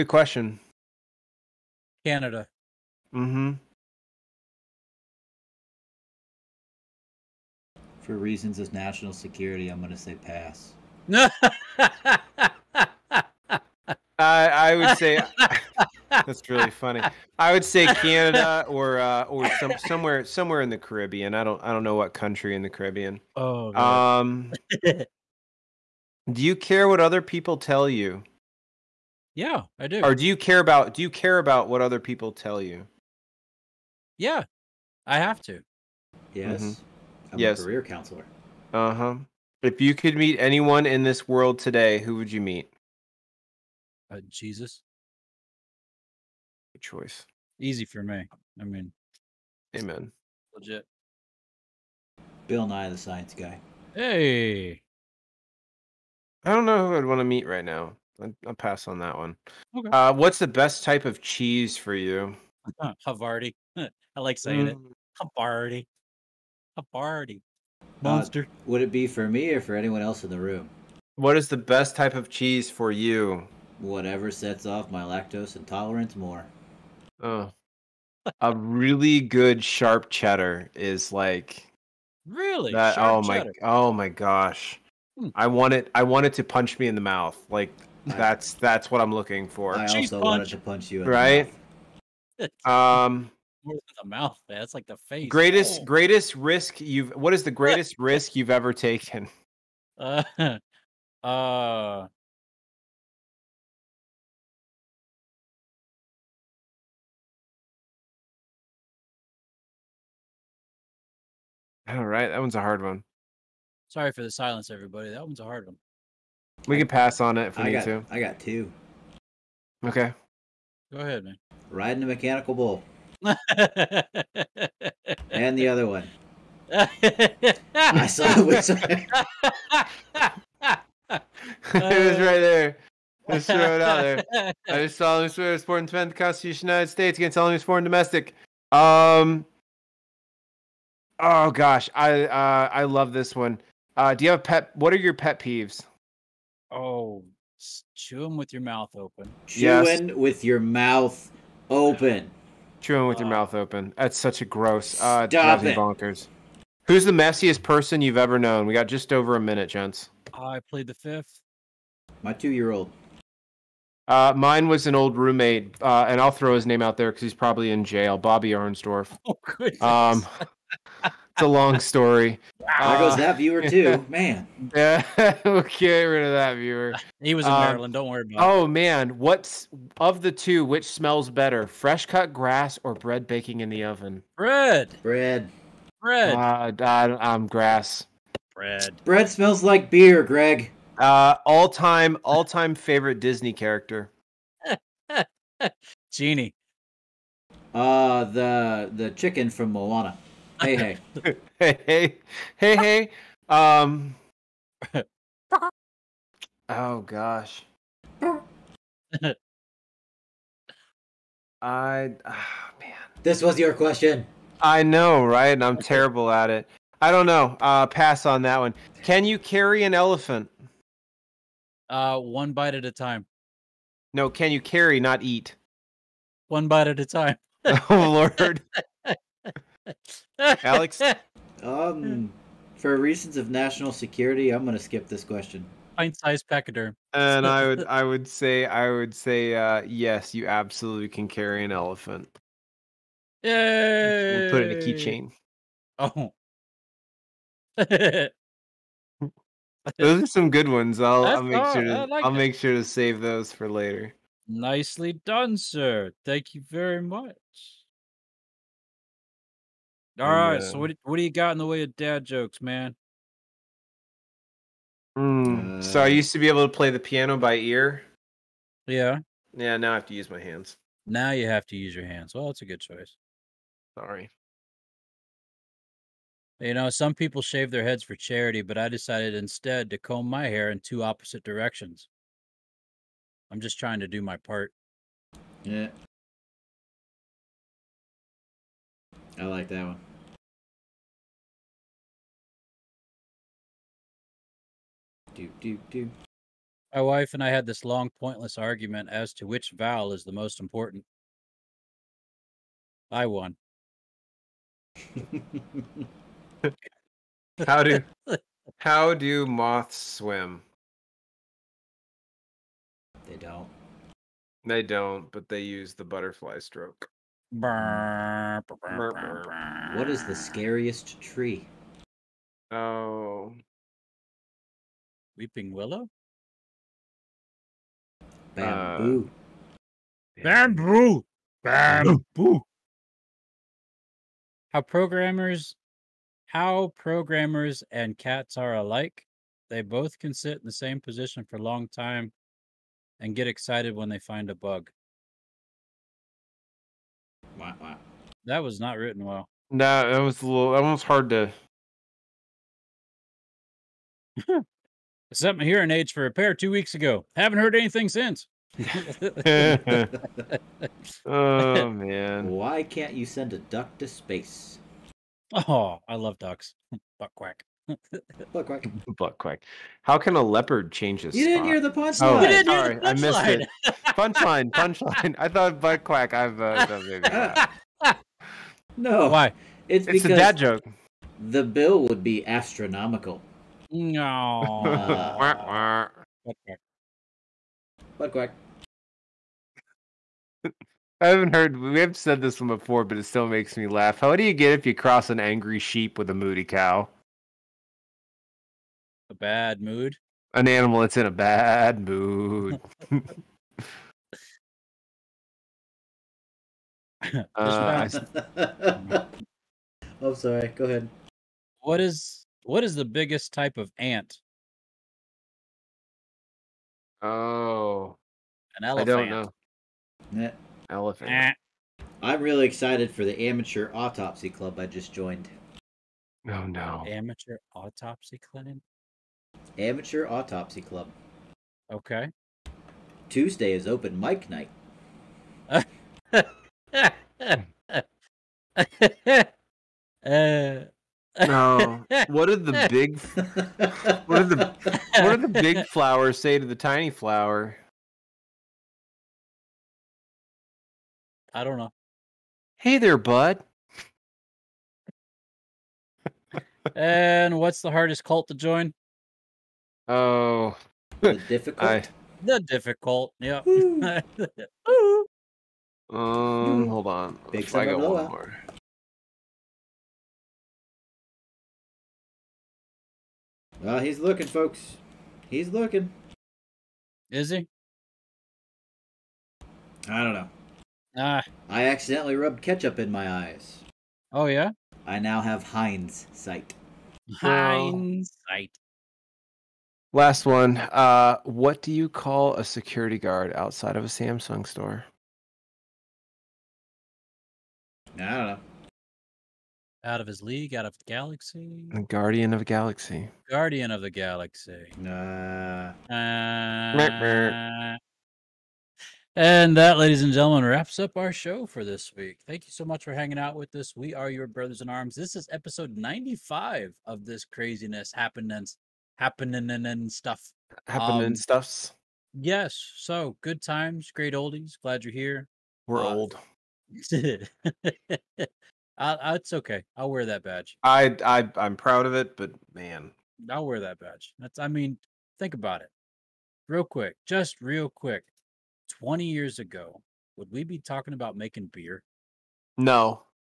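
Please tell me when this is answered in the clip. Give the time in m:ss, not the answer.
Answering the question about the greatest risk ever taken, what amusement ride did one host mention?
2:01.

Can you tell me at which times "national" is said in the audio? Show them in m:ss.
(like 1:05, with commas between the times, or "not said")
0:08, 3:53.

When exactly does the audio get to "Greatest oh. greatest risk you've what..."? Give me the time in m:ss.
1:35.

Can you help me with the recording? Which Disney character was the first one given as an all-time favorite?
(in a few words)
Genie.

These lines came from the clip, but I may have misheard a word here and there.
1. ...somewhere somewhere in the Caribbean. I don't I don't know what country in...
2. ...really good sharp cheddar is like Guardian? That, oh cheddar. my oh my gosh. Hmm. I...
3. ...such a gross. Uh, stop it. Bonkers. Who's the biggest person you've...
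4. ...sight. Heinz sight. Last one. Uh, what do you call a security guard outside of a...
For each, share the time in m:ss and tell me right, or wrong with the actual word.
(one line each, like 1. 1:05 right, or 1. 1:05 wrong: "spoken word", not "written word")
1. 0:19 right
2. 1:18 wrong: "Really", not "Guardian"
3. 2:34 wrong: "messiest", not "biggest"
4. 8:06 right.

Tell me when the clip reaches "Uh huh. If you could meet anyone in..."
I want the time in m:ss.
0:38.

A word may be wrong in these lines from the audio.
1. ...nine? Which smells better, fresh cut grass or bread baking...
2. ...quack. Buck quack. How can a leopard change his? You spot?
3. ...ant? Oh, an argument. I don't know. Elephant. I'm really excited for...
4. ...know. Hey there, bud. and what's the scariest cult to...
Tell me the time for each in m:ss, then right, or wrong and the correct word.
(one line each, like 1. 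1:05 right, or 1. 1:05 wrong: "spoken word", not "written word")
1. 3:00 wrong: "two", not "nine"
2. 6:08 right
3. 6:53 wrong: "elephant", not "argument"
4. 7:31 wrong: "hardest", not "scariest".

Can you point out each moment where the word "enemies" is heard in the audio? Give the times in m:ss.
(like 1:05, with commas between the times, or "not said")
2:17.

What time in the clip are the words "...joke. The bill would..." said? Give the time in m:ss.
6:20.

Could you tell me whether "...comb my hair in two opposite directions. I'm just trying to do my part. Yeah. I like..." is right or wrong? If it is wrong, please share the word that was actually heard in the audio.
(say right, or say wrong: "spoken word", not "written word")
right.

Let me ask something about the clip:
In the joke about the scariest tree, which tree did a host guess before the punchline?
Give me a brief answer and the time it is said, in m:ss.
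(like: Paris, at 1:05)
Weeping Willow, at 5:25.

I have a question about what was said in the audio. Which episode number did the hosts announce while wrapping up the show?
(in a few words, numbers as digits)
95.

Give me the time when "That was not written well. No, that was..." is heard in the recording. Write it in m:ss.
5:48.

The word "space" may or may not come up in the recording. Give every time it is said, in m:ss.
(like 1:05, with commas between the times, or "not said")
6:04.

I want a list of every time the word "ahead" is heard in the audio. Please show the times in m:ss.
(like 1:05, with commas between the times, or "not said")
2:00, 6:50.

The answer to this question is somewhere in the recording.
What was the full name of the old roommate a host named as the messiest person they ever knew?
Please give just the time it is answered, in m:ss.
2:48.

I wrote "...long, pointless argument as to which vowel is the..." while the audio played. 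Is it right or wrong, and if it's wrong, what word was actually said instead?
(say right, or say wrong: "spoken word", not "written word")
right.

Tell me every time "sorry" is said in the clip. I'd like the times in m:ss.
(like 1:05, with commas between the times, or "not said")
1:53, 4:33, 6:12, 6:50.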